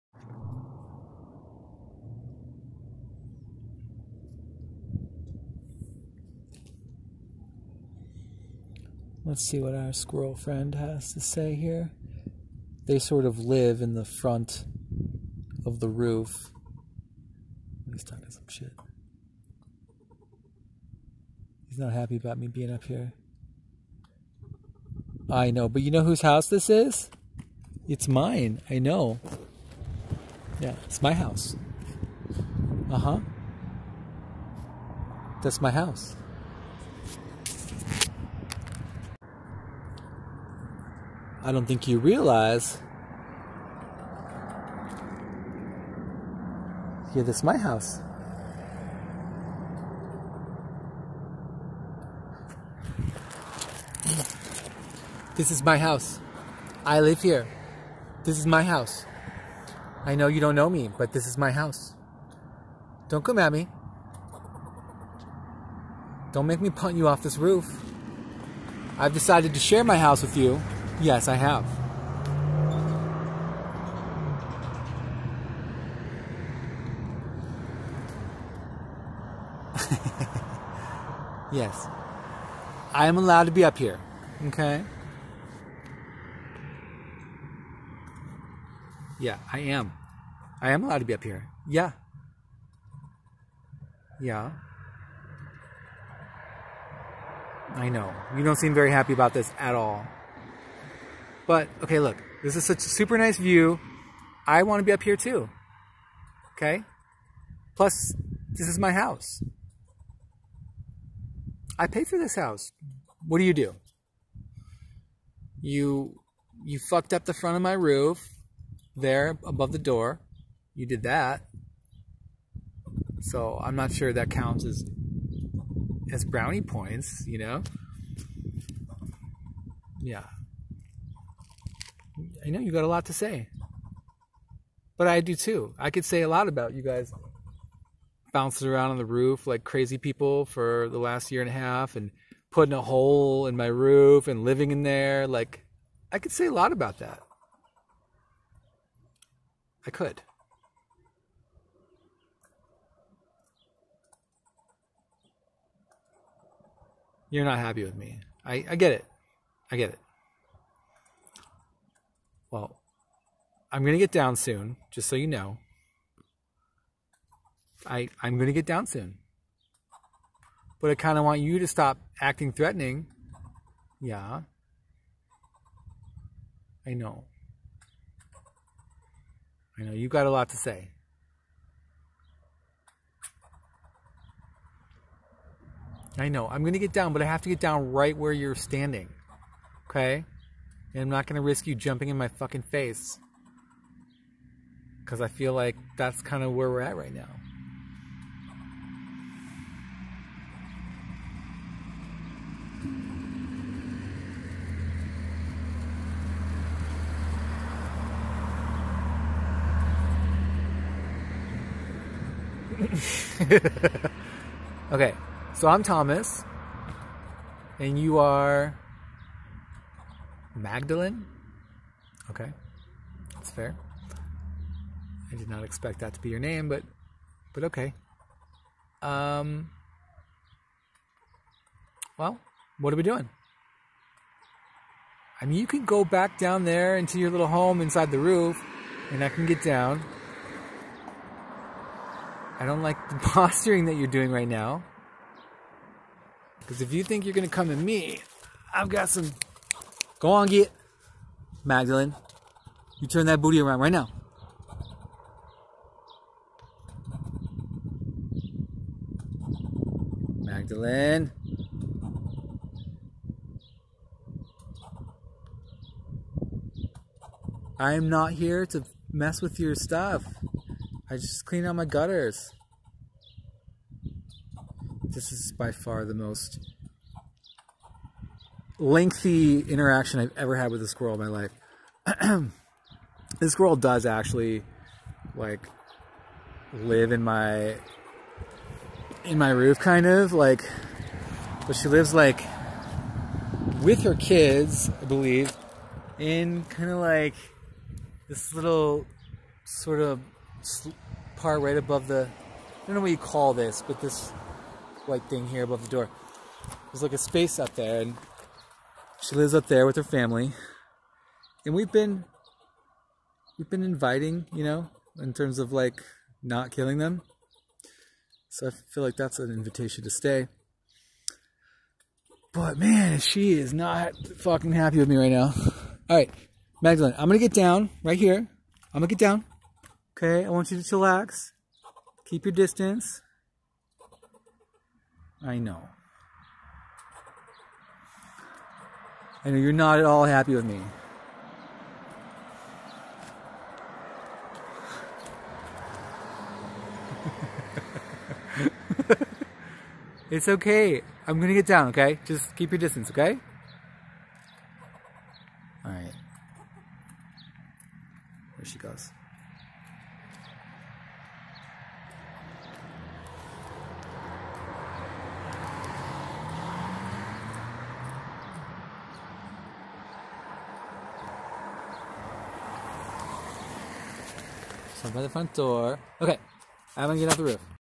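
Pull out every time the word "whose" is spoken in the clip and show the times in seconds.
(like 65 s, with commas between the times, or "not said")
26 s.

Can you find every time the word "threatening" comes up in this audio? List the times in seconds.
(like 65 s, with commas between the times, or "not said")
172 s.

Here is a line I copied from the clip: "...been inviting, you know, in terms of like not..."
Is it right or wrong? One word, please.
right.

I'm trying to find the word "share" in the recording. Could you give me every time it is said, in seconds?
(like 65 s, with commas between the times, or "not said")
69 s.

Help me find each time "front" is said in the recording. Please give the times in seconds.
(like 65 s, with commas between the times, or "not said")
14 s, 117 s, 375 s.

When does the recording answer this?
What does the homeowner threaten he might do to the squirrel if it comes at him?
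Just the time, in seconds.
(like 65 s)
66 s.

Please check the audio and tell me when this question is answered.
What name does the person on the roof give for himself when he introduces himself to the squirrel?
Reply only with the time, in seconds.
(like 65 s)
215 s.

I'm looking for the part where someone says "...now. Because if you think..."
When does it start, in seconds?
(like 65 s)
244 s.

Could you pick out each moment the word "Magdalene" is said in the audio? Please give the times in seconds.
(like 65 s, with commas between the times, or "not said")
220 s, 251 s, 260 s, 326 s.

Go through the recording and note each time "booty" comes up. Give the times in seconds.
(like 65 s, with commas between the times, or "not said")
253 s.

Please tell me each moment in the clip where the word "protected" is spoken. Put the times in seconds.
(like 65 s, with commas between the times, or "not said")
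not said.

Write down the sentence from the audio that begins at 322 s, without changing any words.
But man, she is not fucking happy with me right now.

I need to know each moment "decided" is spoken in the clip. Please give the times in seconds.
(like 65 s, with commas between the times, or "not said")
69 s.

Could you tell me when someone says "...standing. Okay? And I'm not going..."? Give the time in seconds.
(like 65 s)
188 s.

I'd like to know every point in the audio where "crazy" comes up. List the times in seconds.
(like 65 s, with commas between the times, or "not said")
139 s.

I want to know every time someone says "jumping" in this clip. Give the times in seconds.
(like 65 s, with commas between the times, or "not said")
191 s.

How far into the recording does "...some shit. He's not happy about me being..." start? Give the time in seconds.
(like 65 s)
18 s.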